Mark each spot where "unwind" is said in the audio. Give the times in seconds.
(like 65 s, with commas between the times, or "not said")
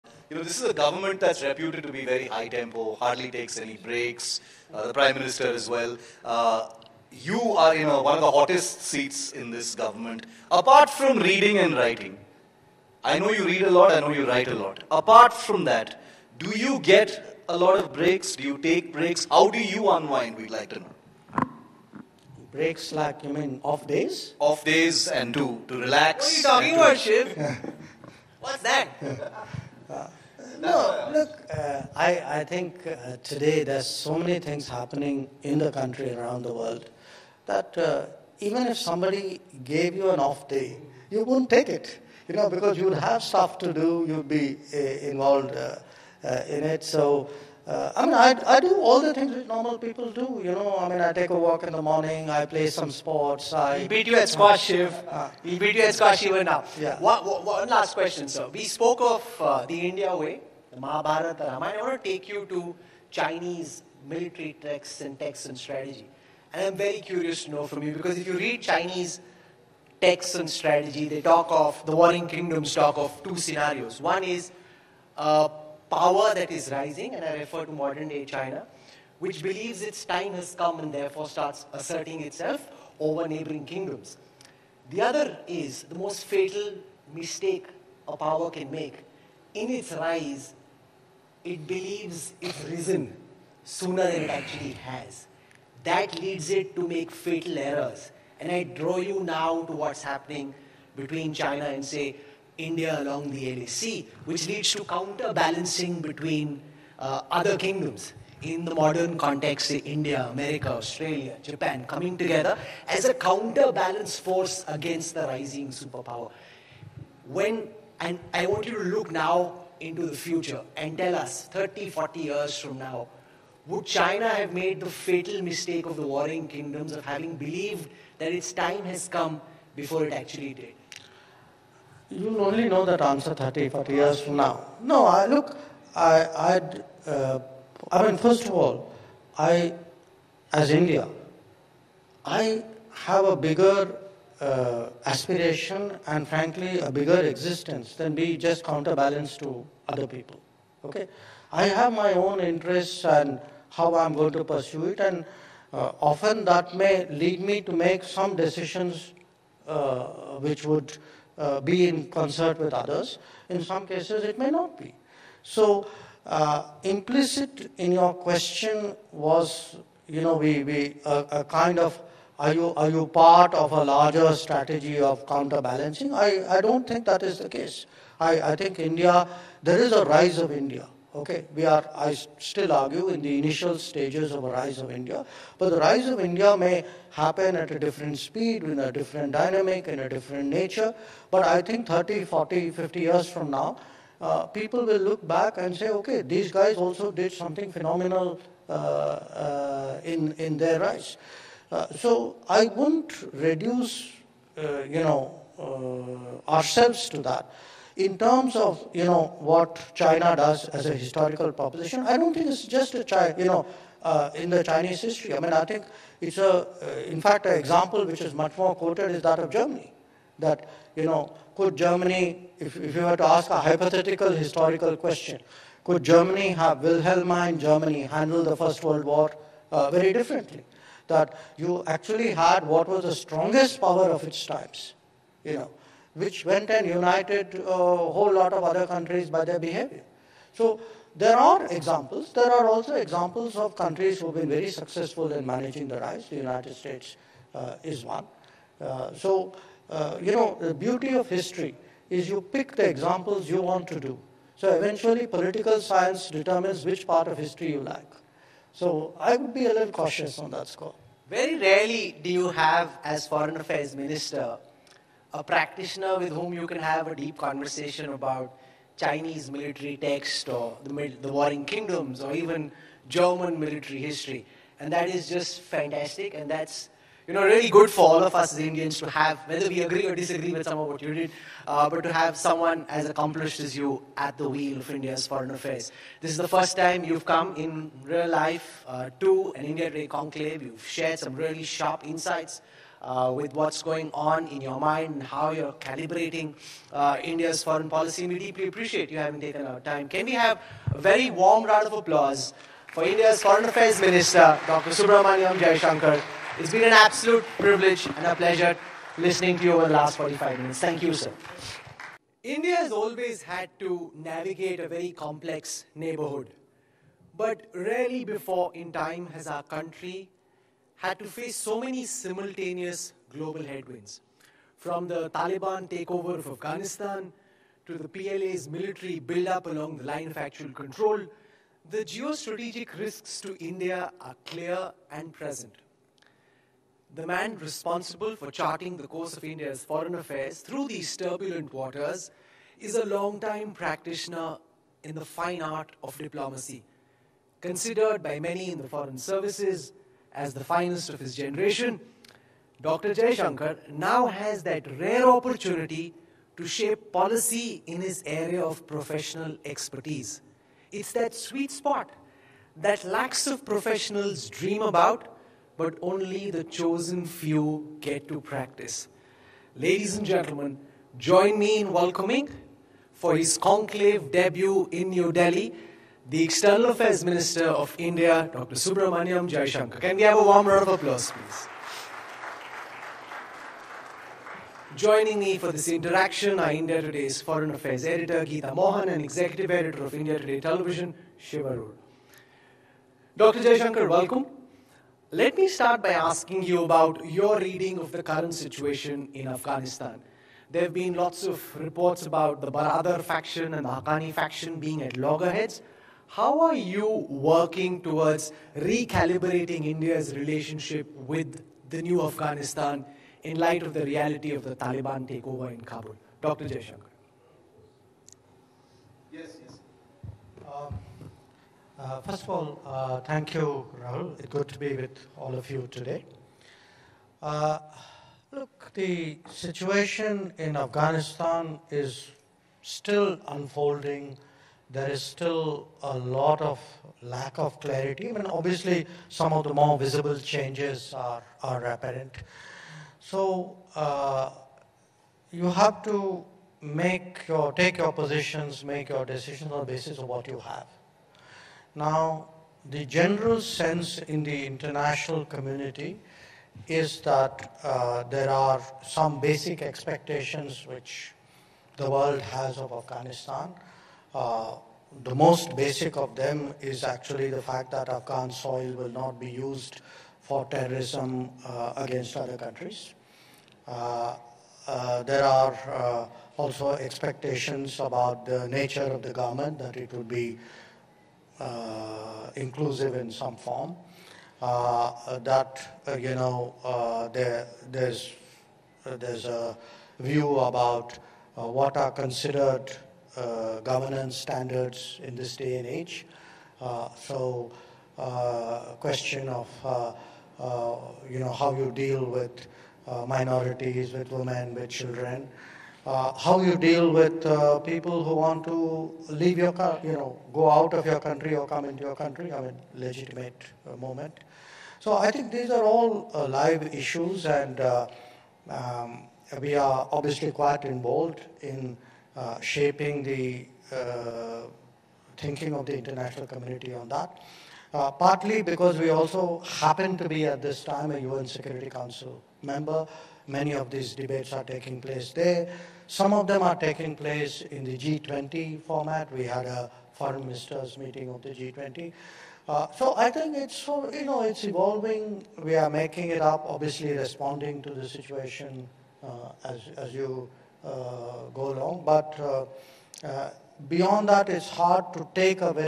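19 s.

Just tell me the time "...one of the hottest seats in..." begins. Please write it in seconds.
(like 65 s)
8 s.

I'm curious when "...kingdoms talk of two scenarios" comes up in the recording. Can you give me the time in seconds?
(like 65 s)
72 s.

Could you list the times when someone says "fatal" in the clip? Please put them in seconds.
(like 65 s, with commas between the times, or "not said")
86 s, 97 s, 124 s.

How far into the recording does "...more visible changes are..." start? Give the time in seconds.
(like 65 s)
439 s.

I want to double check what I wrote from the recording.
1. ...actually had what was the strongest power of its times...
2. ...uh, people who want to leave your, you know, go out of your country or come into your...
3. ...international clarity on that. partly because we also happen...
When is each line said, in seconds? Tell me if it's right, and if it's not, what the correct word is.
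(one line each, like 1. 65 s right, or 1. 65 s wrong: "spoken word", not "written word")
1. 231 s right
2. 507 s right
3. 525 s wrong: "community", not "clarity".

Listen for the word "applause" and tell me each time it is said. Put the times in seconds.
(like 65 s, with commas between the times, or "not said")
301 s, 380 s.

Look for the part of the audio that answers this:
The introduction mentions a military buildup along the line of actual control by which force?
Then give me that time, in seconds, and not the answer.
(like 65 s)
328 s.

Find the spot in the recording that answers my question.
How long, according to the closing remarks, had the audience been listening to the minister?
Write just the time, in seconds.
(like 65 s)
310 s.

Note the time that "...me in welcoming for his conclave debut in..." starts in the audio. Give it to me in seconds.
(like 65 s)
371 s.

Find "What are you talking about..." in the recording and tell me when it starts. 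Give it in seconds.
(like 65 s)
26 s.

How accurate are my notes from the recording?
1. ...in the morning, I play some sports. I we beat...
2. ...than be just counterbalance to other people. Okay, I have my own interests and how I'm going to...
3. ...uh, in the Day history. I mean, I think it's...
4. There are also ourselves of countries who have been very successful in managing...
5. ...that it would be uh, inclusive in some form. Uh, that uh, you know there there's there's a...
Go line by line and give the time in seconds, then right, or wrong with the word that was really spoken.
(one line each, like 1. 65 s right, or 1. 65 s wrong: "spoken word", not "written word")
1. 51 s right
2. 147 s right
3. 214 s wrong: "Chinese", not "Day"
4. 242 s wrong: "examples", not "ourselves"
5. 479 s right.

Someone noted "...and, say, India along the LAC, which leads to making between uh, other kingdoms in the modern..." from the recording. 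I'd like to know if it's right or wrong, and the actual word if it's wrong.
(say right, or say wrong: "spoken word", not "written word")
wrong: "counterbalancing", not "making".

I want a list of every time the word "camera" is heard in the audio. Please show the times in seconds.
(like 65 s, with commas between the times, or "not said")
not said.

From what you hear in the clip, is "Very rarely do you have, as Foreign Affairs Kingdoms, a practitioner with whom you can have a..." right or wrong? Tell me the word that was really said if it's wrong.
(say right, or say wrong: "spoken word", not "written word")
wrong: "Minister", not "Kingdoms".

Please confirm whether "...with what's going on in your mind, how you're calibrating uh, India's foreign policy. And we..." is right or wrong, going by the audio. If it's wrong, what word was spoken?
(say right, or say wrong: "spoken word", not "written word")
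right.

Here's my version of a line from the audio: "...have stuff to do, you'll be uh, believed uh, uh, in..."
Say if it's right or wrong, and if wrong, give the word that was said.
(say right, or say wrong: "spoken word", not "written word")
wrong: "involved", not "believed".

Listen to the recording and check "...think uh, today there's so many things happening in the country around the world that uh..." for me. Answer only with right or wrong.
right.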